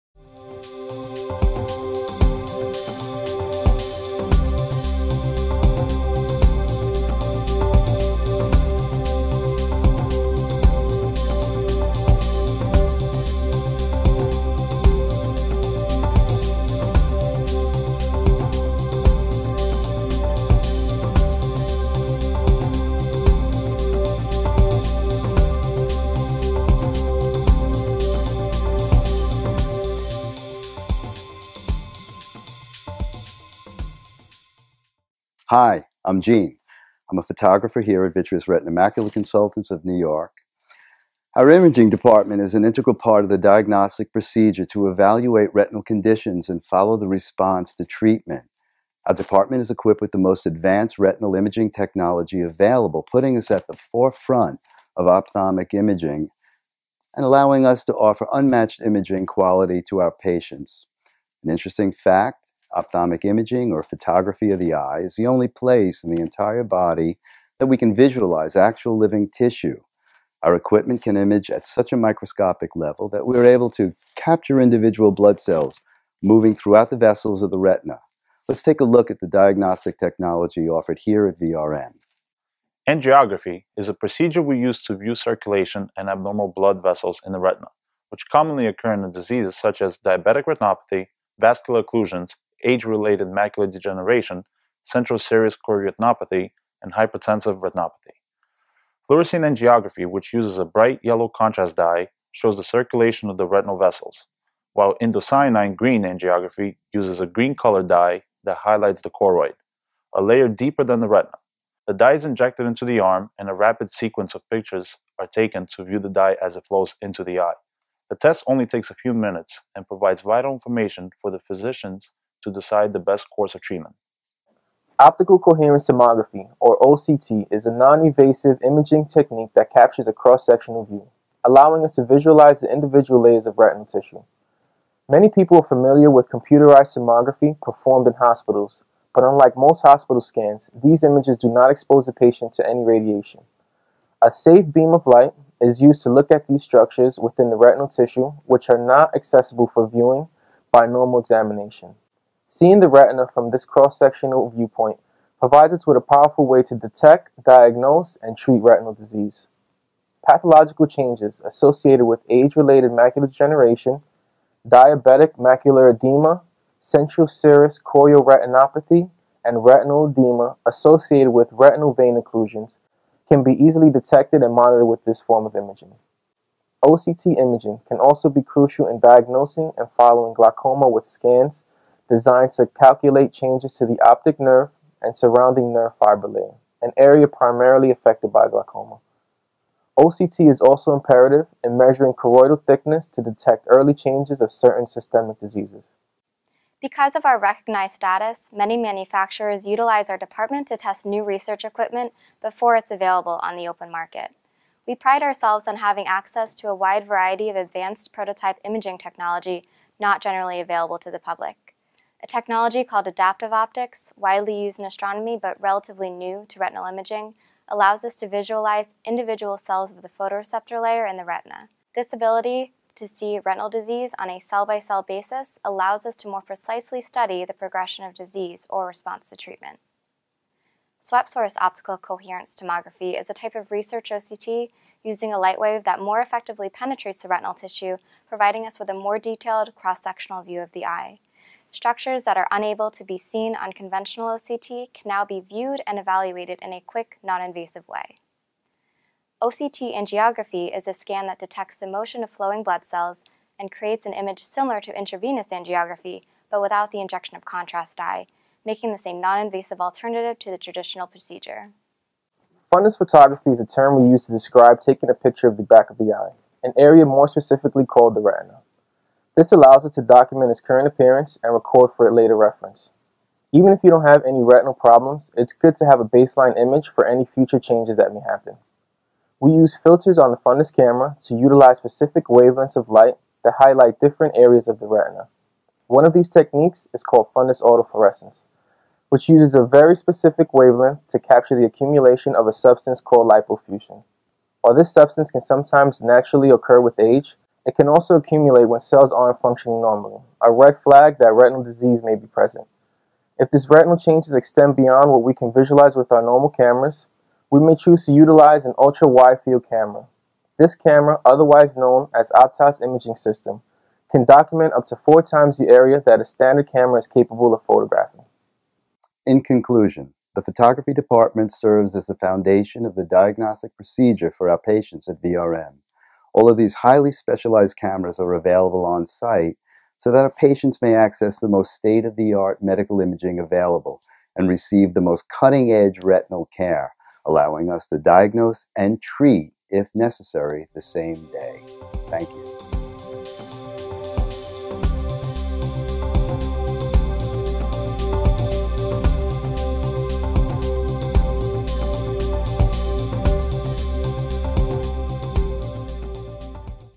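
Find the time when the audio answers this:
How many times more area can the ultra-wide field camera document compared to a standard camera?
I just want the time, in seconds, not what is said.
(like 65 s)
314 s.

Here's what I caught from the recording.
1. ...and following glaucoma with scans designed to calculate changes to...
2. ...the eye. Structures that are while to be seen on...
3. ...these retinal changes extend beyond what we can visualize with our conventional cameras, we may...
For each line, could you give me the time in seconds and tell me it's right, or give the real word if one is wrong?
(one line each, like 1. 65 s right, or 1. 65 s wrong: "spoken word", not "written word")
1. 179 s right
2. 240 s wrong: "unable", not "while"
3. 303 s wrong: "normal", not "conventional".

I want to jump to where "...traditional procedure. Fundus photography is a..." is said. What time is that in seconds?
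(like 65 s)
260 s.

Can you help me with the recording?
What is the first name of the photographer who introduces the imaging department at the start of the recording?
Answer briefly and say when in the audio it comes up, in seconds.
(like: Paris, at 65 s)
Gene, at 36 s.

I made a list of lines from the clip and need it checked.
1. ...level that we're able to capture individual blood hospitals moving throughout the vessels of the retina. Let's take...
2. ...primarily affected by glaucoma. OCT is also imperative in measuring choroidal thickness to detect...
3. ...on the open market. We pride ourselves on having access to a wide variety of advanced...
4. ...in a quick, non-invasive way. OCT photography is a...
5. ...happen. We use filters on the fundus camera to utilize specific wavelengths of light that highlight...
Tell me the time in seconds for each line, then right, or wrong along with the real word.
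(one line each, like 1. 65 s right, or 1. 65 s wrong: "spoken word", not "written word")
1. 72 s wrong: "cells", not "hospitals"
2. 187 s right
3. 203 s right
4. 246 s wrong: "angiography", not "photography"
5. 278 s right.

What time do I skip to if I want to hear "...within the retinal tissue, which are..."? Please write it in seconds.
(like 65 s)
147 s.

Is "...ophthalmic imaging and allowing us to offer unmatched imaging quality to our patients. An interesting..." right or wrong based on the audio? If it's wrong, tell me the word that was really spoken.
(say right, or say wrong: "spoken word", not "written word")
right.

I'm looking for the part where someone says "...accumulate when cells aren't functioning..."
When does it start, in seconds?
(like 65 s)
298 s.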